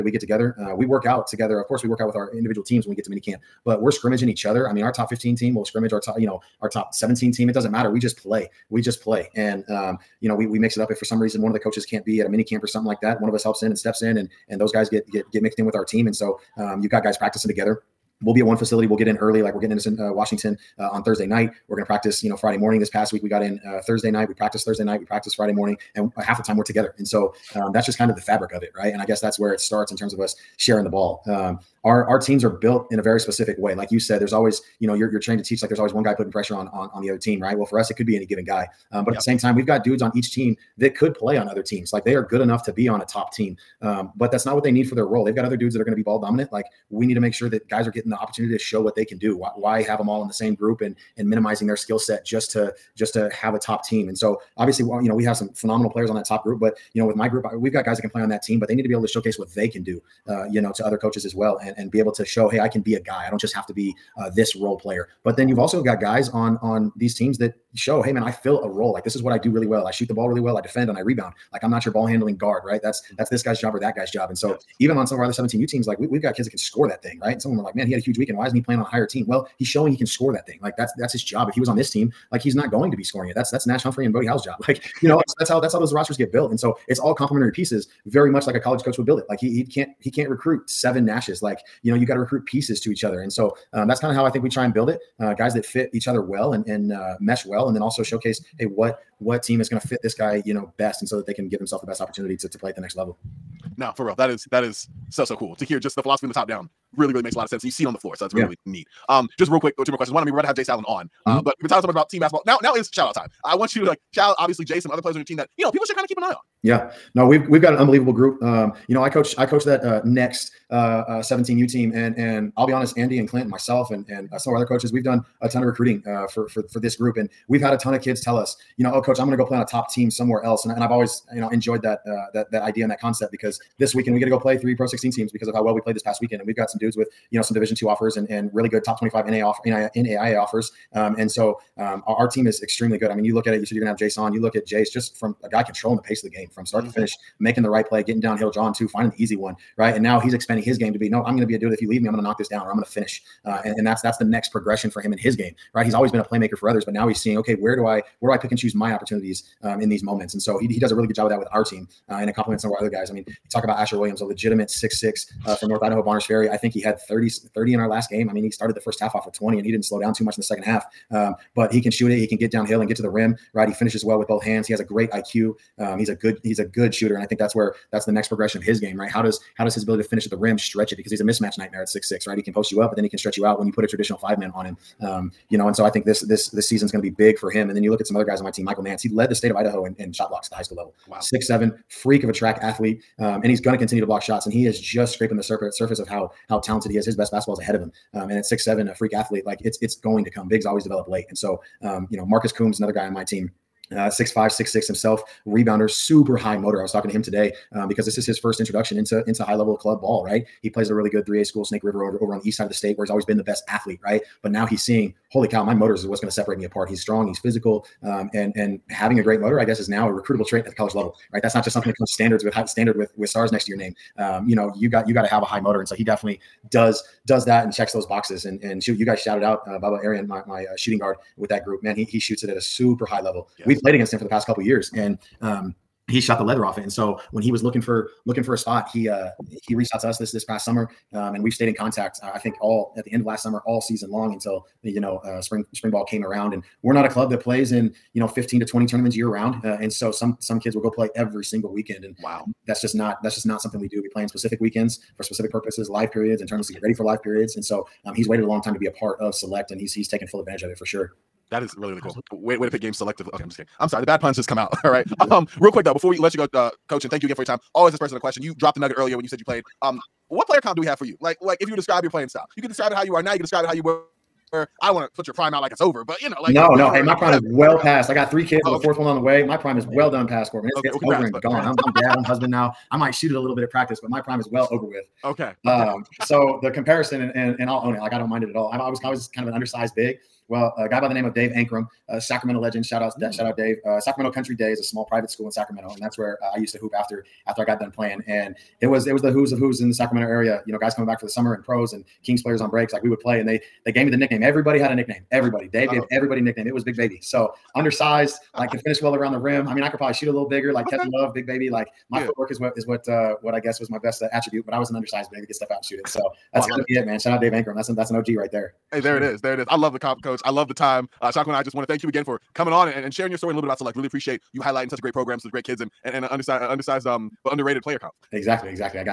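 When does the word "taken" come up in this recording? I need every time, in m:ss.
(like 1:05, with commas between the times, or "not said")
4:20.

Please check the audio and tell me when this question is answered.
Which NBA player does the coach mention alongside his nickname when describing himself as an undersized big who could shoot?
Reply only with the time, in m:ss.
5:10.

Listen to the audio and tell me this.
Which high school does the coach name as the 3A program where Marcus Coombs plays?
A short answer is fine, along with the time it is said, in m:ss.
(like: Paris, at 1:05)
Snake River, at 3:31.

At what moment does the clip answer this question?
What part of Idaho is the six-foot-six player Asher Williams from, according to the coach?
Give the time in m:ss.
2:46.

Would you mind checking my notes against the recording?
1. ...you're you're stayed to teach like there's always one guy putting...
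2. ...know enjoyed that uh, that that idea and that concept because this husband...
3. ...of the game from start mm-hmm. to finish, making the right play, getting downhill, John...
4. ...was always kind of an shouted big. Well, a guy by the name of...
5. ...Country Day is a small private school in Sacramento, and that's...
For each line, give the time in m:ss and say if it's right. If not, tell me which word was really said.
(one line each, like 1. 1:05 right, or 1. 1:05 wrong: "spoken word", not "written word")
1. 0:34 wrong: "trained", not "stayed"
2. 2:11 wrong: "weekend", not "husband"
3. 2:26 right
4. 4:48 wrong: "undersized", not "shouted"
5. 4:54 right.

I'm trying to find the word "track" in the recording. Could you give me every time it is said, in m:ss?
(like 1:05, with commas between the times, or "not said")
3:12.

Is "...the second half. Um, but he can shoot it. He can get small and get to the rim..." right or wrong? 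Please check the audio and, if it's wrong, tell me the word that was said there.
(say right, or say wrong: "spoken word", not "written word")
wrong: "downhill", not "small".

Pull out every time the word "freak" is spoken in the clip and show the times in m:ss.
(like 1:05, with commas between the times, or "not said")
3:11, 3:18.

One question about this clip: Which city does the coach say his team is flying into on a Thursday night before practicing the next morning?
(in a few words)
Washington.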